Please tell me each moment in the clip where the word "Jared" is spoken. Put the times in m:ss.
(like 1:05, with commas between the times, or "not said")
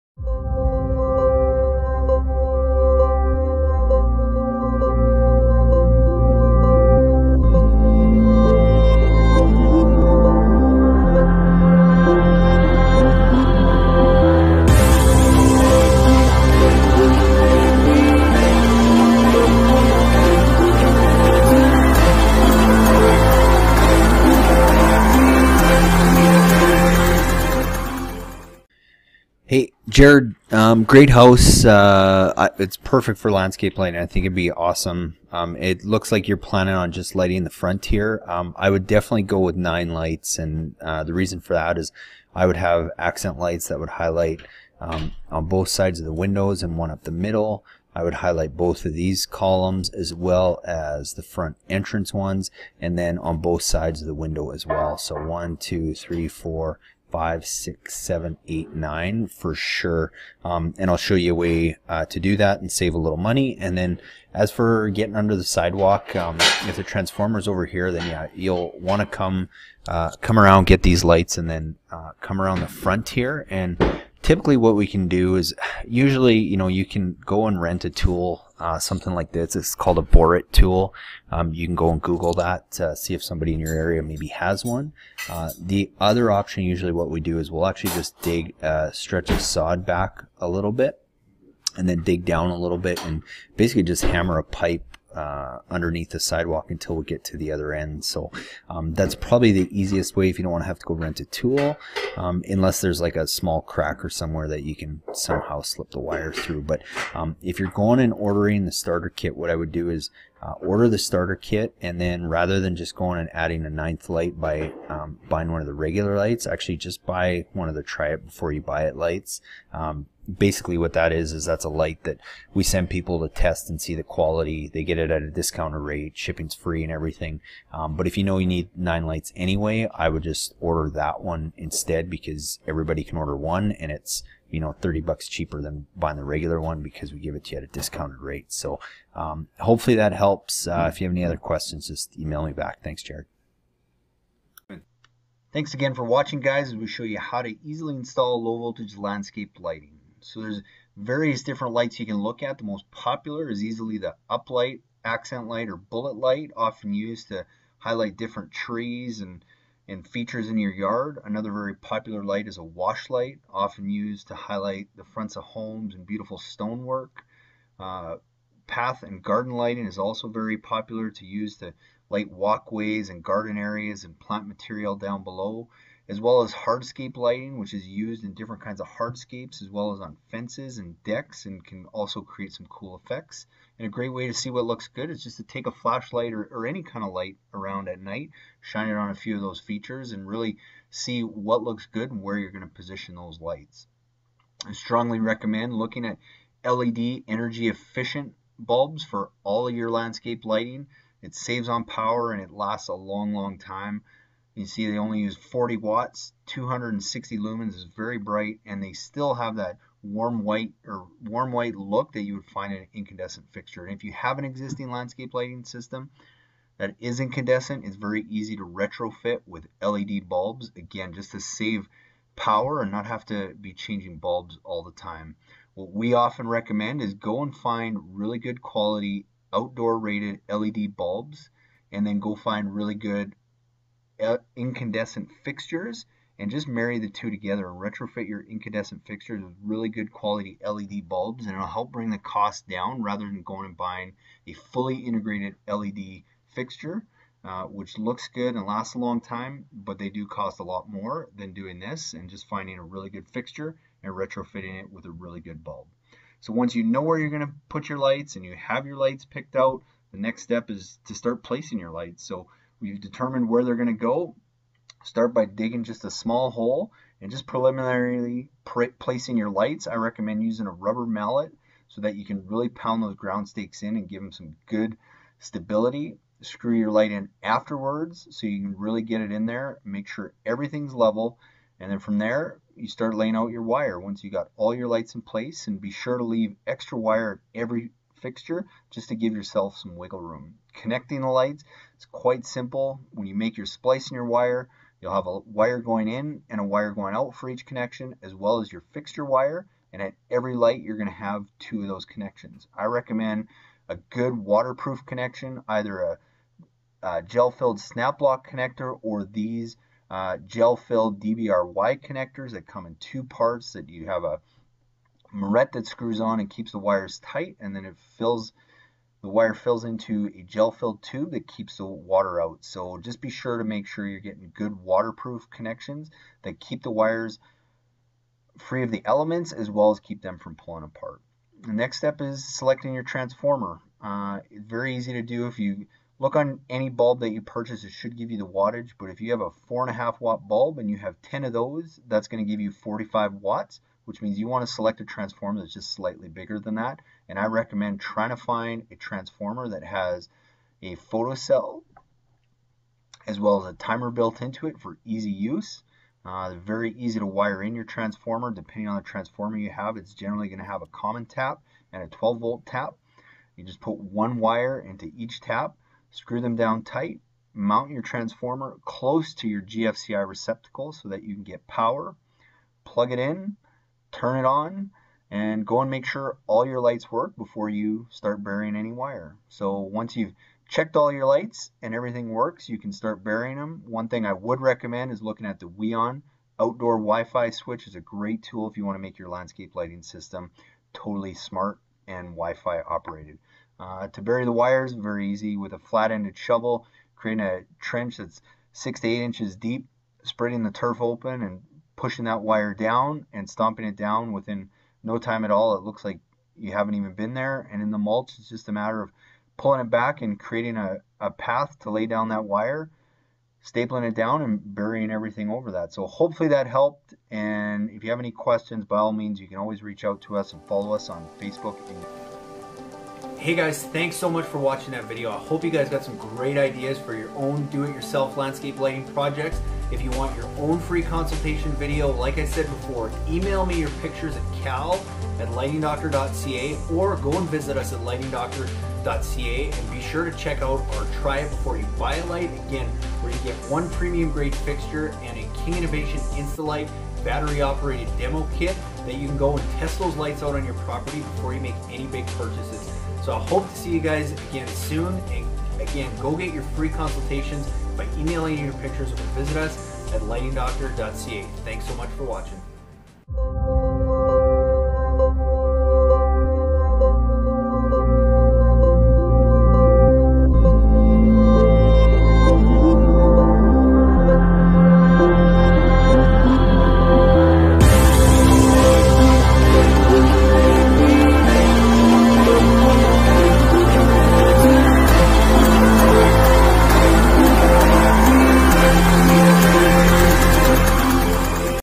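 0:30, 2:23.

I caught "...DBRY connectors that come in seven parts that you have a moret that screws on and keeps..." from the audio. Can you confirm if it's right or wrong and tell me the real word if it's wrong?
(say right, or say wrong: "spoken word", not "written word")
wrong: "two", not "seven".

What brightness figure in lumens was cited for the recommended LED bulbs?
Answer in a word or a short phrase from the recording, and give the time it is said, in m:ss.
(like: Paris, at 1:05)
260, at 3:26.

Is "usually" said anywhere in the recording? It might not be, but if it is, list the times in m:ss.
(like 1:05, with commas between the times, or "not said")
1:15, 1:26.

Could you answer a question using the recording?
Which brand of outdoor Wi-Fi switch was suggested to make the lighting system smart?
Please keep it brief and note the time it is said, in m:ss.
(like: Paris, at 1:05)
Weon, at 6:25.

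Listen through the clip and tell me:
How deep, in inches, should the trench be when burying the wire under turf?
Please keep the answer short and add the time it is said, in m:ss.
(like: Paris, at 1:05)
6 to 8 inches, at 6:38.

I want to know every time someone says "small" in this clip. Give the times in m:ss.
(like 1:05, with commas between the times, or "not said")
1:43, 4:26.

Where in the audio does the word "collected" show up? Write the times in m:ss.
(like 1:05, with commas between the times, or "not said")
not said.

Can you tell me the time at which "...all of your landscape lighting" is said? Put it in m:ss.
3:19.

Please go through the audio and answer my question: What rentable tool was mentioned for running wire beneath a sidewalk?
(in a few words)
borit tool.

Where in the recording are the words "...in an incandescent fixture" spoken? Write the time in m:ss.
3:32.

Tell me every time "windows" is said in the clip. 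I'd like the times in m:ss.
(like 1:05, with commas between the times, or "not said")
0:46, 0:54.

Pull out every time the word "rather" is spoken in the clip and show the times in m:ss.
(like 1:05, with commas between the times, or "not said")
1:52, 4:03.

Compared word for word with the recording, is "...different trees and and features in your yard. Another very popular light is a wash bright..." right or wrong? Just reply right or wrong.
wrong.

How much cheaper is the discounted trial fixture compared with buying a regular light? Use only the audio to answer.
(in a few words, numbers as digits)
30 bucks.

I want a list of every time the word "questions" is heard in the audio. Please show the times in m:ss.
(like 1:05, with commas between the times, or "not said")
2:21, 6:58.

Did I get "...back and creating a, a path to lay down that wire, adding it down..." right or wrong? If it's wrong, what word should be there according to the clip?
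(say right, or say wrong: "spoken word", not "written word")
wrong: "stapling", not "adding".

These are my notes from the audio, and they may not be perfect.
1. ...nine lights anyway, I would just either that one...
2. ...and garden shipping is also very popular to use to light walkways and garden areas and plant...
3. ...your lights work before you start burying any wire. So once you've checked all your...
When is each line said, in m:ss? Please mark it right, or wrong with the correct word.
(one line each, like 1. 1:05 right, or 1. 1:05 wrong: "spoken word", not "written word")
1. 2:08 wrong: "order", not "either"
2. 2:49 wrong: "lighting", not "shipping"
3. 6:16 right.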